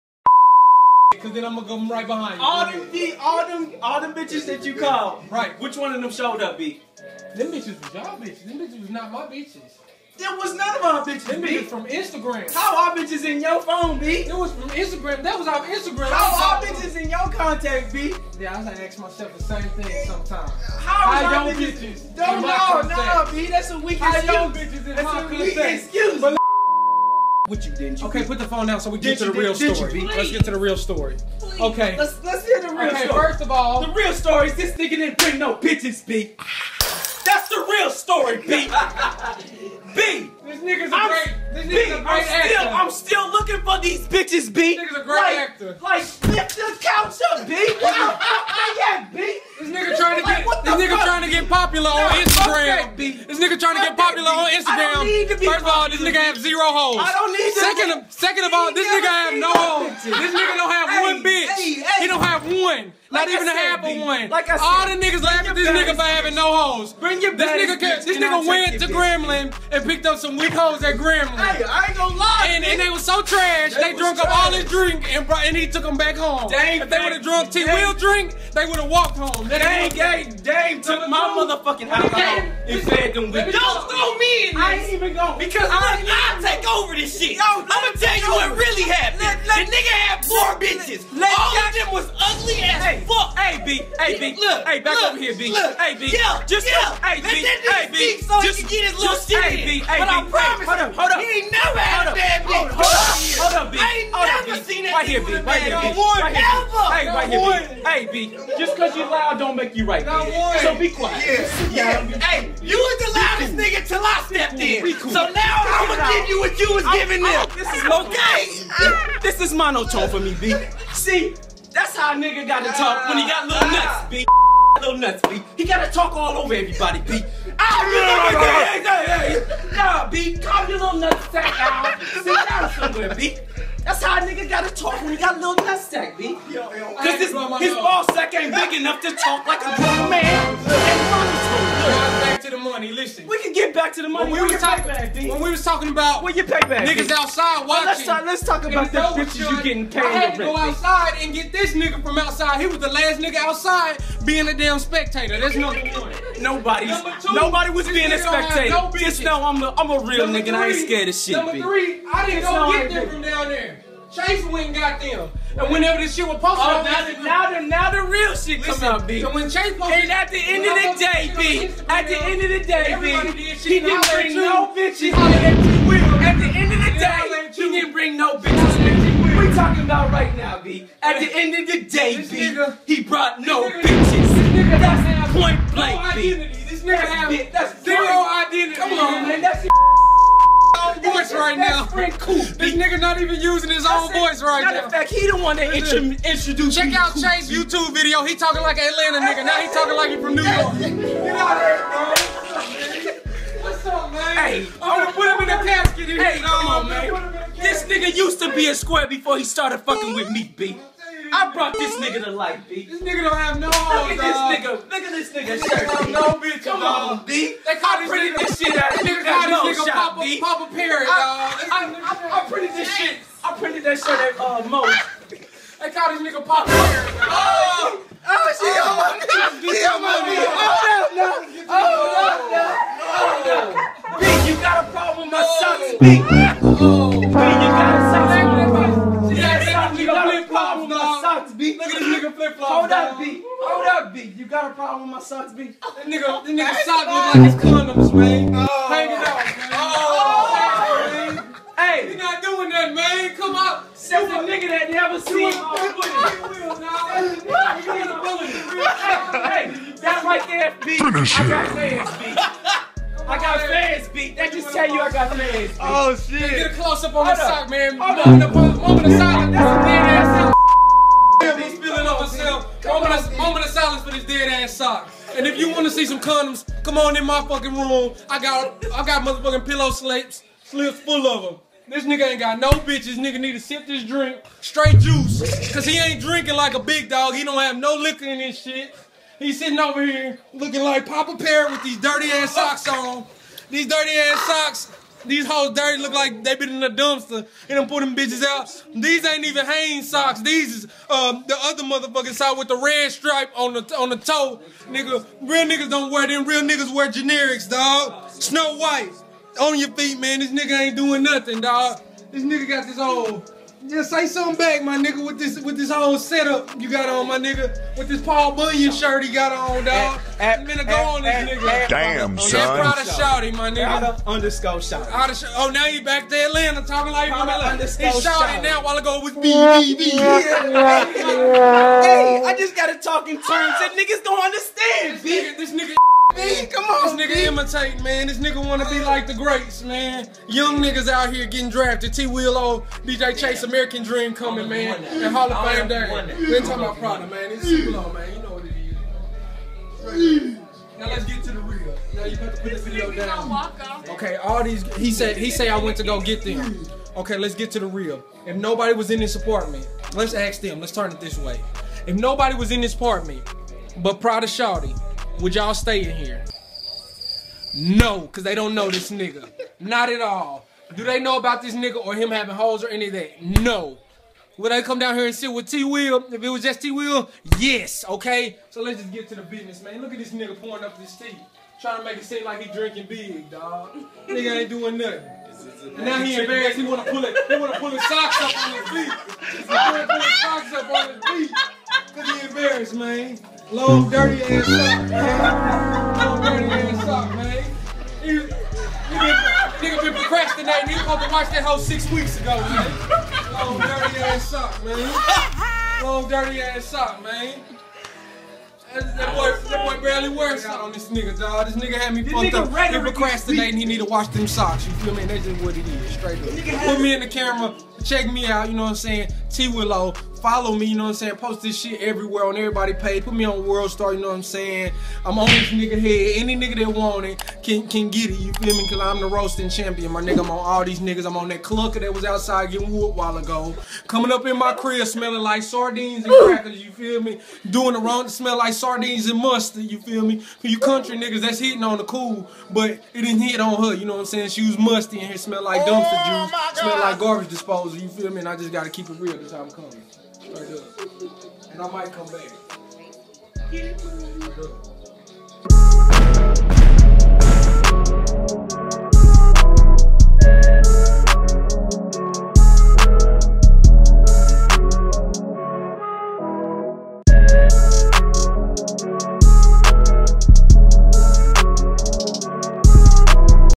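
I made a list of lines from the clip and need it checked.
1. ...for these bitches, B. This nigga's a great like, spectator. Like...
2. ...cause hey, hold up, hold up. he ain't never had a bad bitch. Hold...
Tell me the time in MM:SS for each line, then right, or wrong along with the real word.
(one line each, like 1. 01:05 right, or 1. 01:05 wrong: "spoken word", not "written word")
1. 00:43 wrong: "actor", not "spectator"
2. 01:40 wrong: "promise", not "cause".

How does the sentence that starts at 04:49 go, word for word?
He's sitting over here looking like Papa Parrot with these dirty ass socks on.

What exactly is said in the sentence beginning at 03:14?
Matter of fact, he the one that intro- introduced Check out Chase's Chase YouTube video.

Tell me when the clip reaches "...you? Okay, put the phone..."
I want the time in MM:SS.
00:28.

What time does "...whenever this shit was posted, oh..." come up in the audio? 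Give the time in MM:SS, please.
02:45.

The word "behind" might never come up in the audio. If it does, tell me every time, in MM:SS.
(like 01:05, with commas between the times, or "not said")
00:02.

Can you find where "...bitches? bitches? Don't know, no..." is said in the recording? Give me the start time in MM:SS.
00:21.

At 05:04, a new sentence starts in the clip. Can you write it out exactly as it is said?
Nigga, real niggas don't wear them.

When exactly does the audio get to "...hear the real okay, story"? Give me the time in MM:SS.
00:32.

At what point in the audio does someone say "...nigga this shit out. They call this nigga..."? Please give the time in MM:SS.
03:38.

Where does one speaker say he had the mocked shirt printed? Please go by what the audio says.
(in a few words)
Mo's.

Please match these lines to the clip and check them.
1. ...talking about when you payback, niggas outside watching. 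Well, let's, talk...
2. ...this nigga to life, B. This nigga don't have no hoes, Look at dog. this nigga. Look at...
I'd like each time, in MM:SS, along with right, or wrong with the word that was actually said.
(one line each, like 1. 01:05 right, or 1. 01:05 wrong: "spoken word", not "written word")
1. 02:25 right
2. 03:31 right.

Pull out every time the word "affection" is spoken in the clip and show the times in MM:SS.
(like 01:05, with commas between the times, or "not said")
not said.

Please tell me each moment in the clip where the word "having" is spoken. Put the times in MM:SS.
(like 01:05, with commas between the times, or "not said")
01:06, 06:12.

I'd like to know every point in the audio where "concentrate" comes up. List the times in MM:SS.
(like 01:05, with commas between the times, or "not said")
not said.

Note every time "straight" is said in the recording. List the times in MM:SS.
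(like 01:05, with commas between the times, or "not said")
04:44, 06:56.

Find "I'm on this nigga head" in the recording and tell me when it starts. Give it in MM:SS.
07:05.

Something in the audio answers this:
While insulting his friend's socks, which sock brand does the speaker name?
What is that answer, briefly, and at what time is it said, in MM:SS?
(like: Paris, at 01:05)
Hanes, at 04:59.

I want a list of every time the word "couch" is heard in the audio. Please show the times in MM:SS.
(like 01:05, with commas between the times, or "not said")
00:46.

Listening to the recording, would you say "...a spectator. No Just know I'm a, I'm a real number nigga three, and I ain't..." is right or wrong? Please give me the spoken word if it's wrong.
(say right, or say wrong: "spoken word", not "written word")
right.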